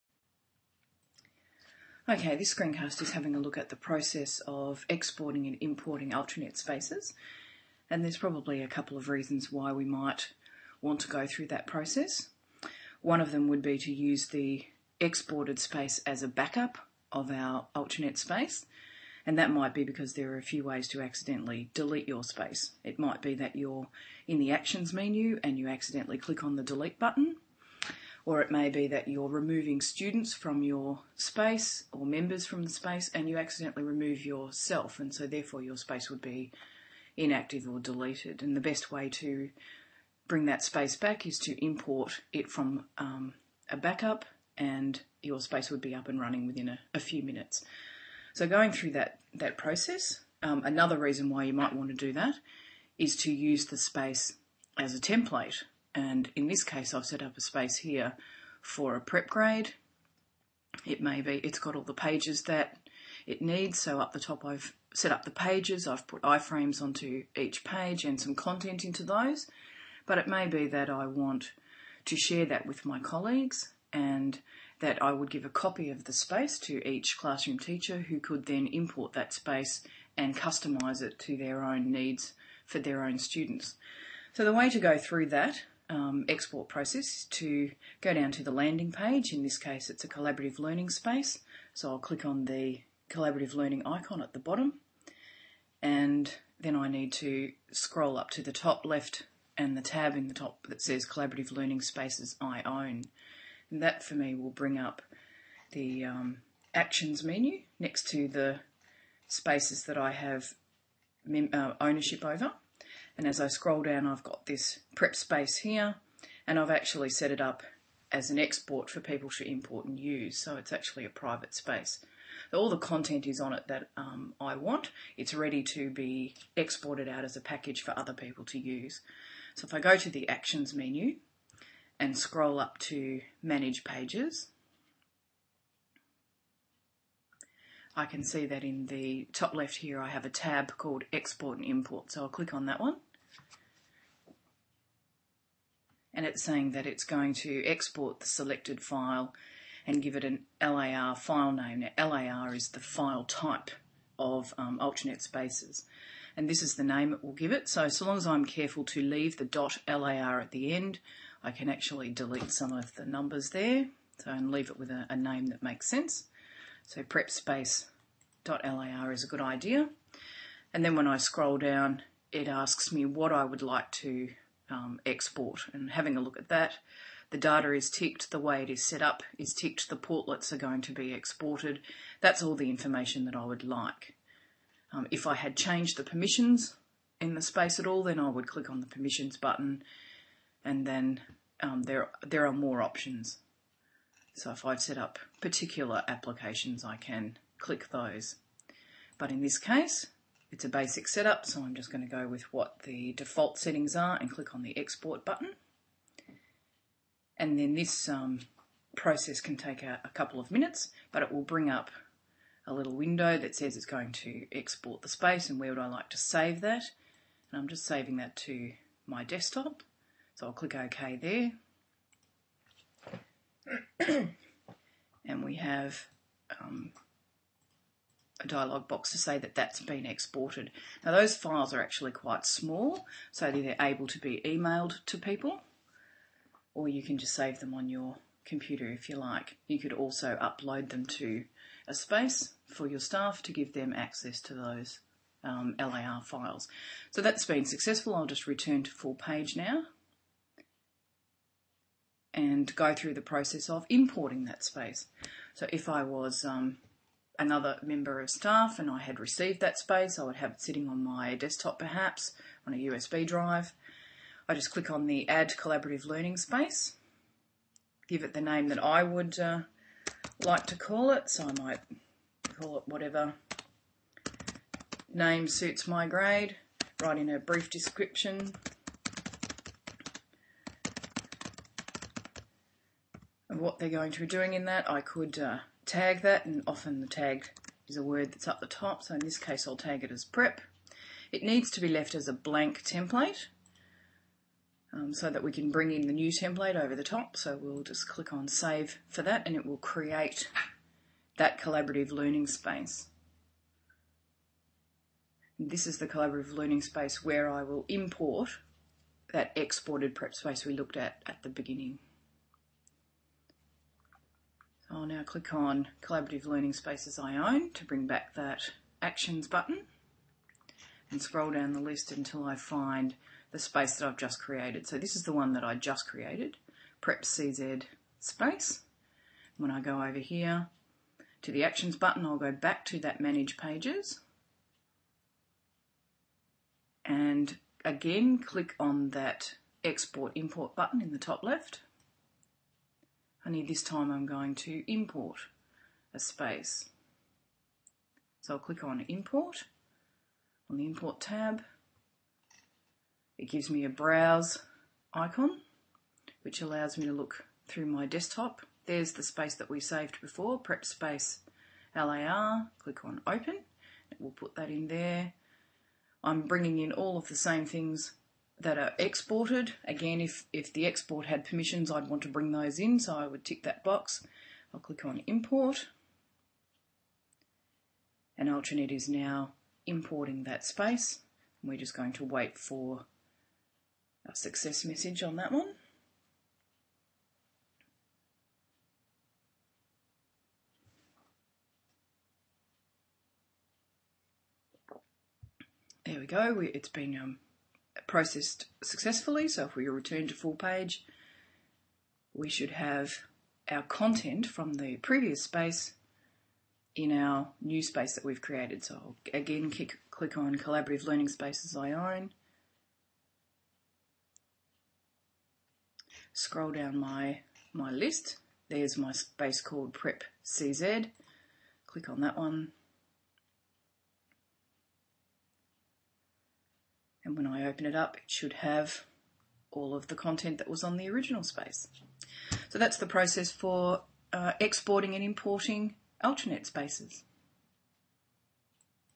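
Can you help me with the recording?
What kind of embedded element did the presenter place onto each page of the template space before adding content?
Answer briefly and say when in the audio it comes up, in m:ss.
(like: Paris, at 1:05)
iframes, at 1:06.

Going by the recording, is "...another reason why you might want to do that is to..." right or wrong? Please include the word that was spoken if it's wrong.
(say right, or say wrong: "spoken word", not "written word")
right.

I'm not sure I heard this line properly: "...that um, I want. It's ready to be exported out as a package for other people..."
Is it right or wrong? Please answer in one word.
right.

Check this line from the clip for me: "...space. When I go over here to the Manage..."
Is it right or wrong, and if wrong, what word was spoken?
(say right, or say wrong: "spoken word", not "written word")
wrong: "Actions", not "Manage".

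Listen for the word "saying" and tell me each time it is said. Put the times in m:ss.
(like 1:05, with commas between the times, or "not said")
2:26.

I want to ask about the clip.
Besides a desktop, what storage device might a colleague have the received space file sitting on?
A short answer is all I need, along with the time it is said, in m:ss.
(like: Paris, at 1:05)
USB drive, at 4:22.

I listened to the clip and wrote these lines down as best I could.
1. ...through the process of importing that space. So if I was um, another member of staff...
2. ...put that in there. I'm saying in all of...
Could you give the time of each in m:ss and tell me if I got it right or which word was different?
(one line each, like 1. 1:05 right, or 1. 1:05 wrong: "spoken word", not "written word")
1. 4:12 right
2. 6:04 wrong: "bringing", not "saying".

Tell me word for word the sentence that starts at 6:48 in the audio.
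So I'll again click, click on Collaborative Learning Spaces I own.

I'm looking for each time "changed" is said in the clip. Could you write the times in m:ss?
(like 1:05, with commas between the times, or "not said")
3:05.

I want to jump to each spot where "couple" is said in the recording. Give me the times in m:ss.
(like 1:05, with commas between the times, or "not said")
0:08, 3:30.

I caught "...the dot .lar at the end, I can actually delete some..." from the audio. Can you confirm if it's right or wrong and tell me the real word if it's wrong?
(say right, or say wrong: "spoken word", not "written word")
right.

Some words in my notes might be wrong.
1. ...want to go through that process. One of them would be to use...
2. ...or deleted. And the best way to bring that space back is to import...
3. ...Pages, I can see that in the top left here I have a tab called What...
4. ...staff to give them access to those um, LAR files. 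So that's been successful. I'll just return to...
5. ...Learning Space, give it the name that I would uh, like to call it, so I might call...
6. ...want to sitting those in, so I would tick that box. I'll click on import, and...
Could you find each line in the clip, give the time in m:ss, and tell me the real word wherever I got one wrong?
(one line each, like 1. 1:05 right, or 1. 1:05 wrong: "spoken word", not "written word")
1. 0:10 right
2. 0:37 right
3. 2:13 wrong: "Export", not "What"
4. 4:02 right
5. 4:26 right
6. 6:12 wrong: "bring", not "sitting".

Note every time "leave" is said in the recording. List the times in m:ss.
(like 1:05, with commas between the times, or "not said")
2:39, 2:44.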